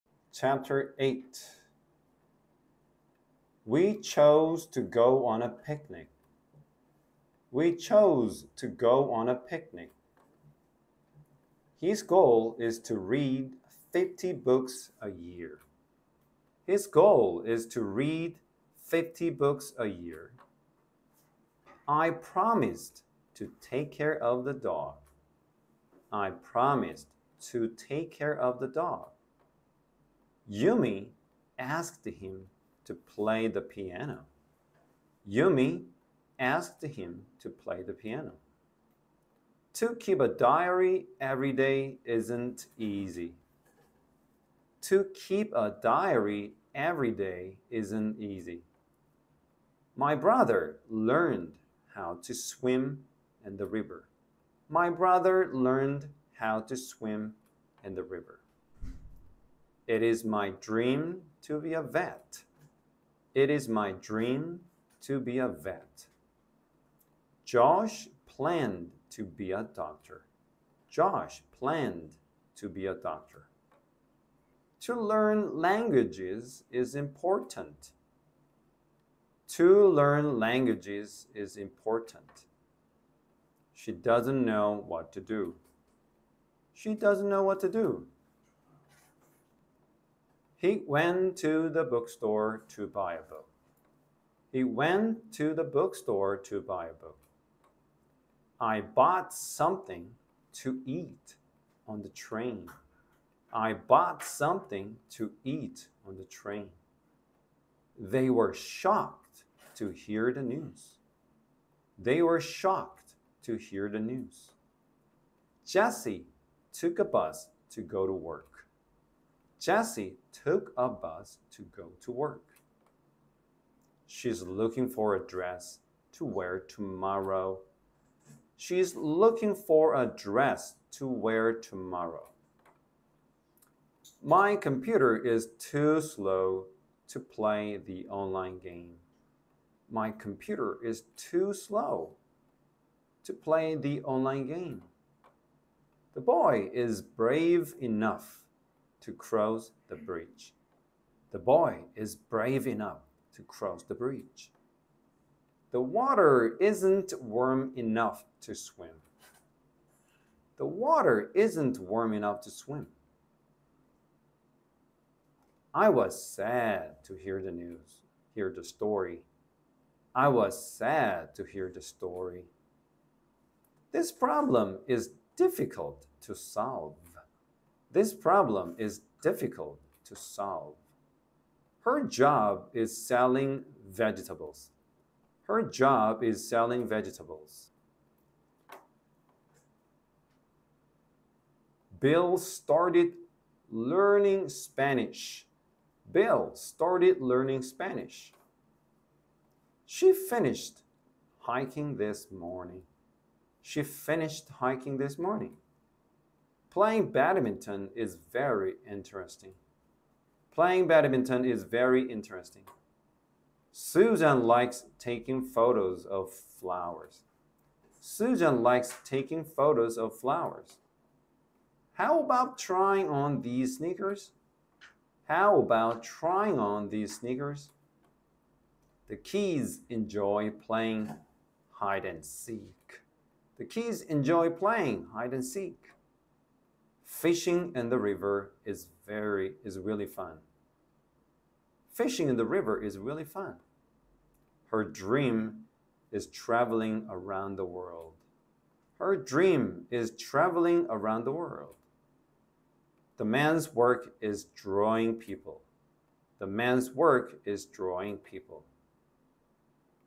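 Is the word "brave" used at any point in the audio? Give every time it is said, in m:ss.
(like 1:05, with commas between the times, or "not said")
2:27, 2:32.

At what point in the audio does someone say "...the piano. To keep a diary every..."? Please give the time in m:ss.
0:37.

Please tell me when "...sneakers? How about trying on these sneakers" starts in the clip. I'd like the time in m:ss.
3:43.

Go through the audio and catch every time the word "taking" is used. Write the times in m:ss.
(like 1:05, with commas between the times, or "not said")
3:34, 3:39.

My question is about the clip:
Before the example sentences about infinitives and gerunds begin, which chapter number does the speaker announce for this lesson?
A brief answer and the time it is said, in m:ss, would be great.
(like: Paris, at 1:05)
8, at 0:00.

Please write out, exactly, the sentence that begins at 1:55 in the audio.
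Jesse took a bus to go to work.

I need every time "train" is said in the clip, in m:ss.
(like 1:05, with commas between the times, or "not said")
1:42, 1:46.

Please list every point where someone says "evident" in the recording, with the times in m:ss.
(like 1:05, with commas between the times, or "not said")
not said.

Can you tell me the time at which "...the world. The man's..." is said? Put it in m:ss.
4:11.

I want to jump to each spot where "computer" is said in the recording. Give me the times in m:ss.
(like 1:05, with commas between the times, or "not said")
2:14, 2:20.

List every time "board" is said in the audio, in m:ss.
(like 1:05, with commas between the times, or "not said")
not said.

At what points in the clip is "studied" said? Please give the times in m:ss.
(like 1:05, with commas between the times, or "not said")
not said.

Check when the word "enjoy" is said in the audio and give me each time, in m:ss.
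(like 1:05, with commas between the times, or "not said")
3:49, 3:54.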